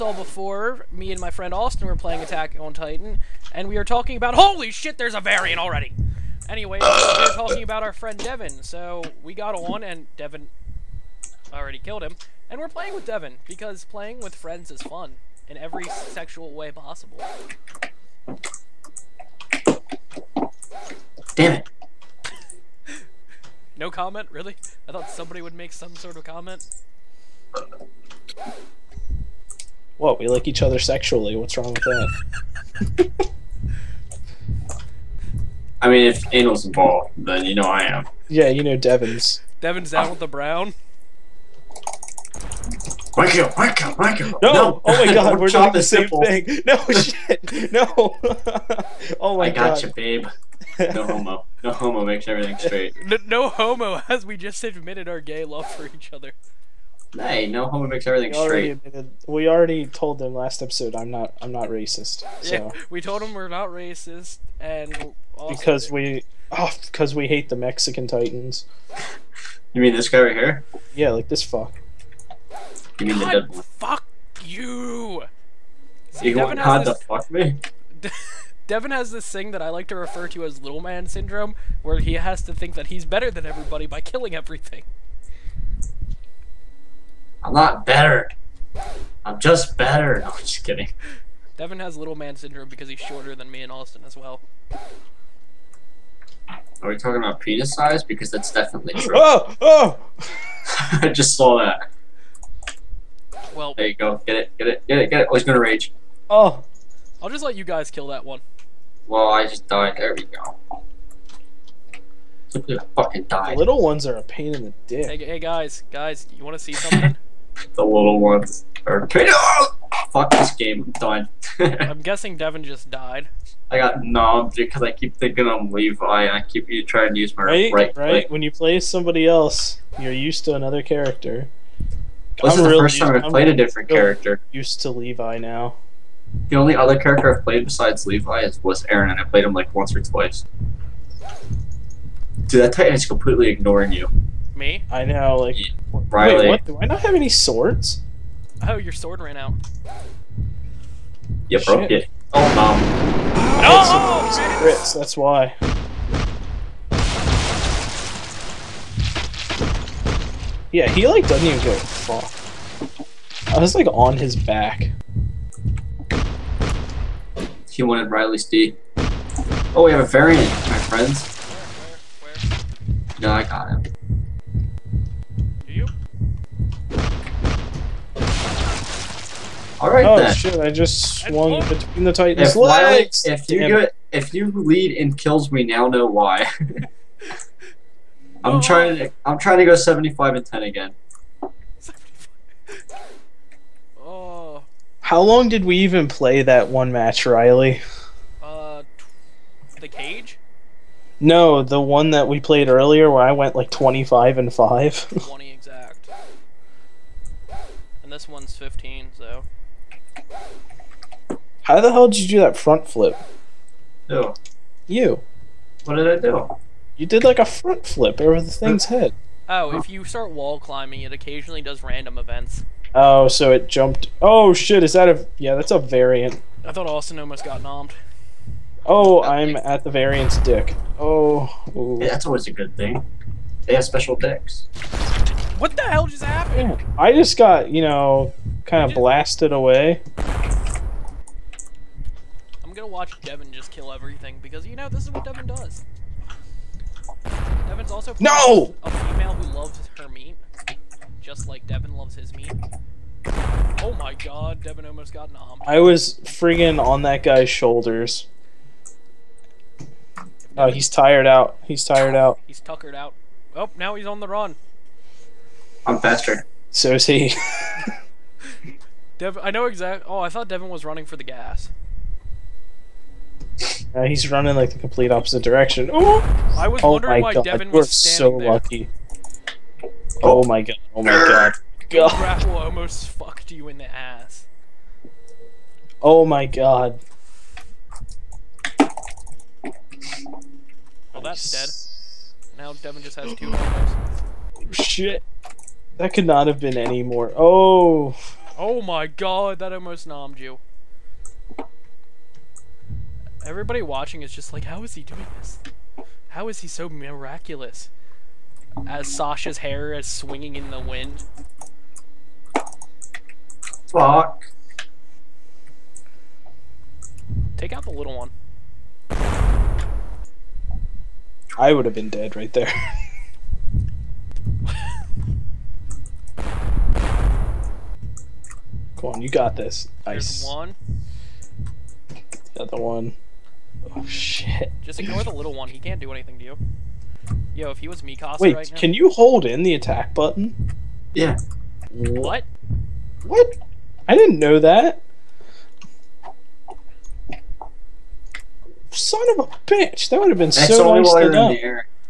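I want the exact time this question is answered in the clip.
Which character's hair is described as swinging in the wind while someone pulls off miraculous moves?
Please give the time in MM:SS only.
05:09.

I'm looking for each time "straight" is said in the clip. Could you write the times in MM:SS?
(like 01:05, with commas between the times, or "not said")
00:52, 00:58.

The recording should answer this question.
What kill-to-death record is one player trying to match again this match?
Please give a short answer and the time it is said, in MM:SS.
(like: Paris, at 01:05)
75 and 10, at 03:09.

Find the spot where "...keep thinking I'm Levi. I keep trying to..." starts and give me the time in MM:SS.
02:04.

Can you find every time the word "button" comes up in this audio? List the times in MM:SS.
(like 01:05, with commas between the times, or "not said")
05:40.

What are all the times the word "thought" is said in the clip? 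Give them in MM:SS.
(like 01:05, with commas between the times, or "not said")
00:24, 03:46, 04:30.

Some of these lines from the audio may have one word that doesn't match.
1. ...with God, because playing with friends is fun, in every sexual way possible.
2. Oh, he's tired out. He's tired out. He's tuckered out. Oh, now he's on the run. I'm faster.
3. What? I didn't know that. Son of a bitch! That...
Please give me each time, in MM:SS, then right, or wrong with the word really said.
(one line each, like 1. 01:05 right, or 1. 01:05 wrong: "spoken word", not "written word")
1. 00:12 wrong: "Devin", not "God"
2. 04:20 right
3. 05:43 right.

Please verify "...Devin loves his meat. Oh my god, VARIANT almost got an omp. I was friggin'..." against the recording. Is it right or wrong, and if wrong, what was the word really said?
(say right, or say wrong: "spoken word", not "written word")
wrong: "Devin", not "VARIANT".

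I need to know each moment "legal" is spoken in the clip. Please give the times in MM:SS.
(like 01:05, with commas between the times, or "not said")
not said.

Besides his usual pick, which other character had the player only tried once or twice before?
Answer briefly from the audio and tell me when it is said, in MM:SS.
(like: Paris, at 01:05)
Eren, at 02:18.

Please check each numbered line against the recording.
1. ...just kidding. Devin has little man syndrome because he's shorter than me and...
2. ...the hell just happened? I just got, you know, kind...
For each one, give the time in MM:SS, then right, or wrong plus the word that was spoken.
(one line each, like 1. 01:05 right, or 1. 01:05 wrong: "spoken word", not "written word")
1. 01:30 right
2. 03:55 right.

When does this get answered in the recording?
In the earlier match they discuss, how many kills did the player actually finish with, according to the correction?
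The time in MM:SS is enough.
03:25.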